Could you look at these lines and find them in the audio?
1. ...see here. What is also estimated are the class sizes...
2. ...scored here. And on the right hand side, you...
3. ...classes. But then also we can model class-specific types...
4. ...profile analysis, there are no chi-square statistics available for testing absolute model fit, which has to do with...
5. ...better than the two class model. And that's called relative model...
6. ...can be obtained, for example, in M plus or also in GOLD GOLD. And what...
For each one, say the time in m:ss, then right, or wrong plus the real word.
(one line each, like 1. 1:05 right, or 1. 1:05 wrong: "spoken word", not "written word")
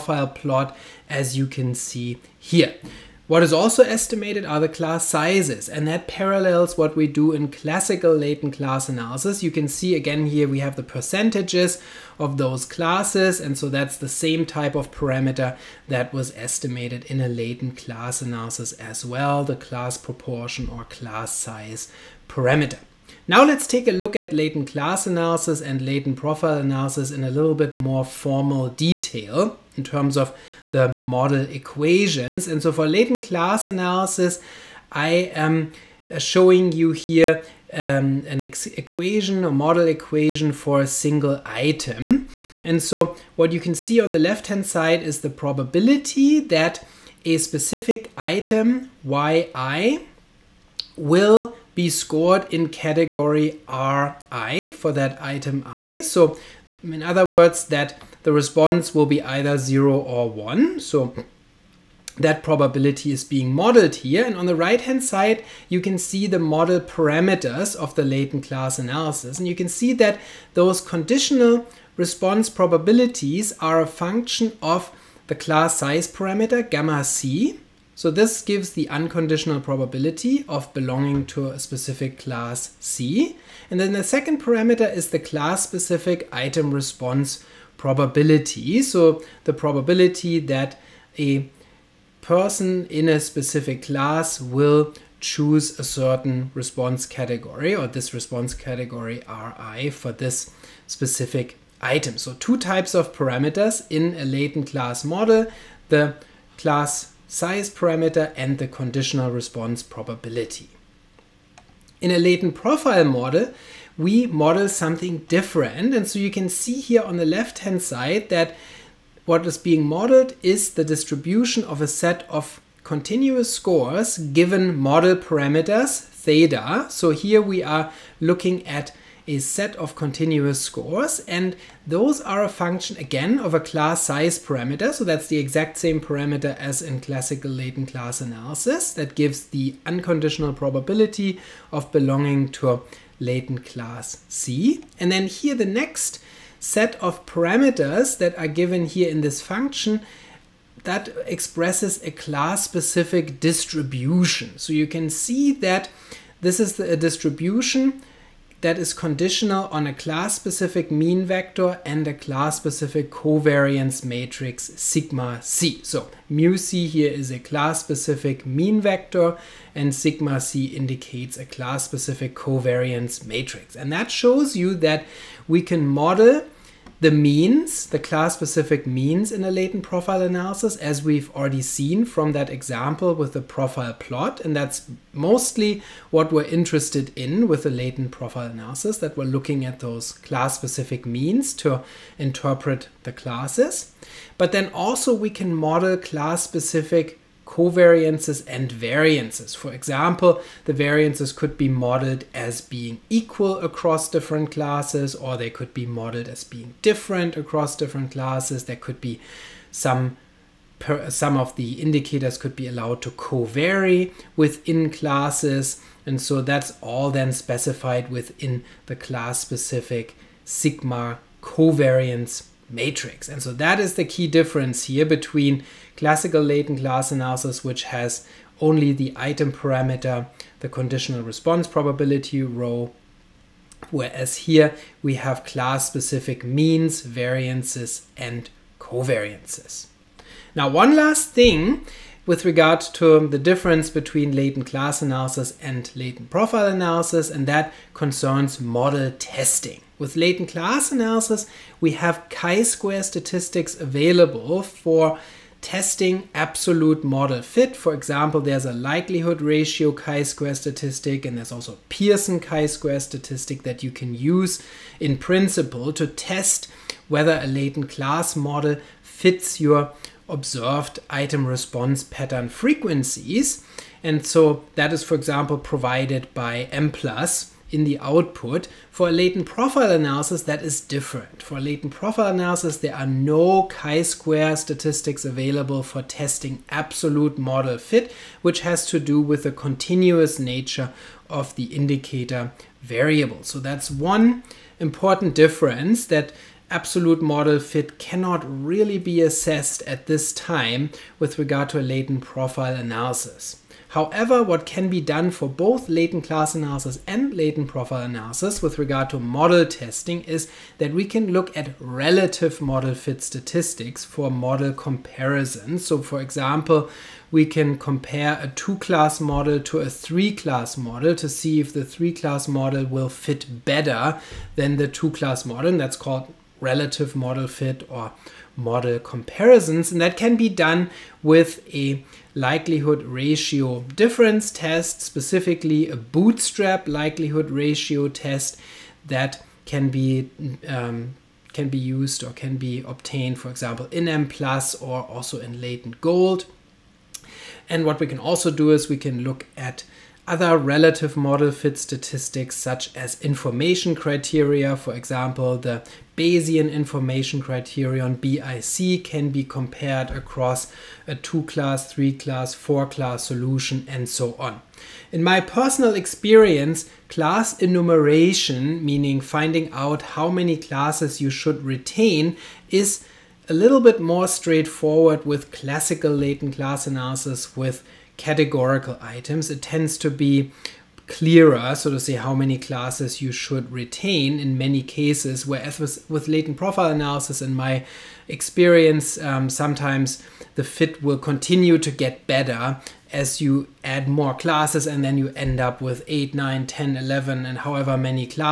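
1. 0:01 right
2. 1:03 wrong: "modeled", not "scored"
3. 3:13 wrong: "covariances", not "types"
4. 4:41 right
5. 5:23 right
6. 5:42 wrong: "Latent", not "GOLD".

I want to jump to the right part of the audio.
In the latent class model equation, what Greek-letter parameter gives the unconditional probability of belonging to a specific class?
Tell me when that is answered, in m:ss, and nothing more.
1:16.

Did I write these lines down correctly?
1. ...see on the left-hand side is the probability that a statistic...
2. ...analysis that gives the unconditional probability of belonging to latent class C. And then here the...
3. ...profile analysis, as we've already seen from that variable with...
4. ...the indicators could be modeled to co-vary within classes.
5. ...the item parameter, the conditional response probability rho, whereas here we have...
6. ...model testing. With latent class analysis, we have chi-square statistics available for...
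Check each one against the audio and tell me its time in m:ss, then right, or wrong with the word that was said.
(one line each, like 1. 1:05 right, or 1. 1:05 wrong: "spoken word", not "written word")
1. 0:43 wrong: "specific", not "statistic"
2. 2:18 right
3. 2:59 wrong: "example", not "variable"
4. 3:31 wrong: "allowed", not "modeled"
5. 3:48 right
6. 4:08 right.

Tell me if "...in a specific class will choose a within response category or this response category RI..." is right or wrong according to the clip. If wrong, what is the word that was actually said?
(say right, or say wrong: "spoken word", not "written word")
wrong: "certain", not "within".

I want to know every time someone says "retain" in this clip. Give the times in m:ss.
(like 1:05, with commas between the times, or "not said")
6:11, 6:23.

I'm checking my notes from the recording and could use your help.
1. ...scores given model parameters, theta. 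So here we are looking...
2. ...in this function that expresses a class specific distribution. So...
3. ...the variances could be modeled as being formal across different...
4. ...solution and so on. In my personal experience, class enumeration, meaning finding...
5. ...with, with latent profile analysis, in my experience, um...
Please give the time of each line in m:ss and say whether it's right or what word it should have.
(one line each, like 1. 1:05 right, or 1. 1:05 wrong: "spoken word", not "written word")
1. 2:03 right
2. 2:29 right
3. 3:20 wrong: "equal", not "formal"
4. 6:03 right
5. 6:25 right.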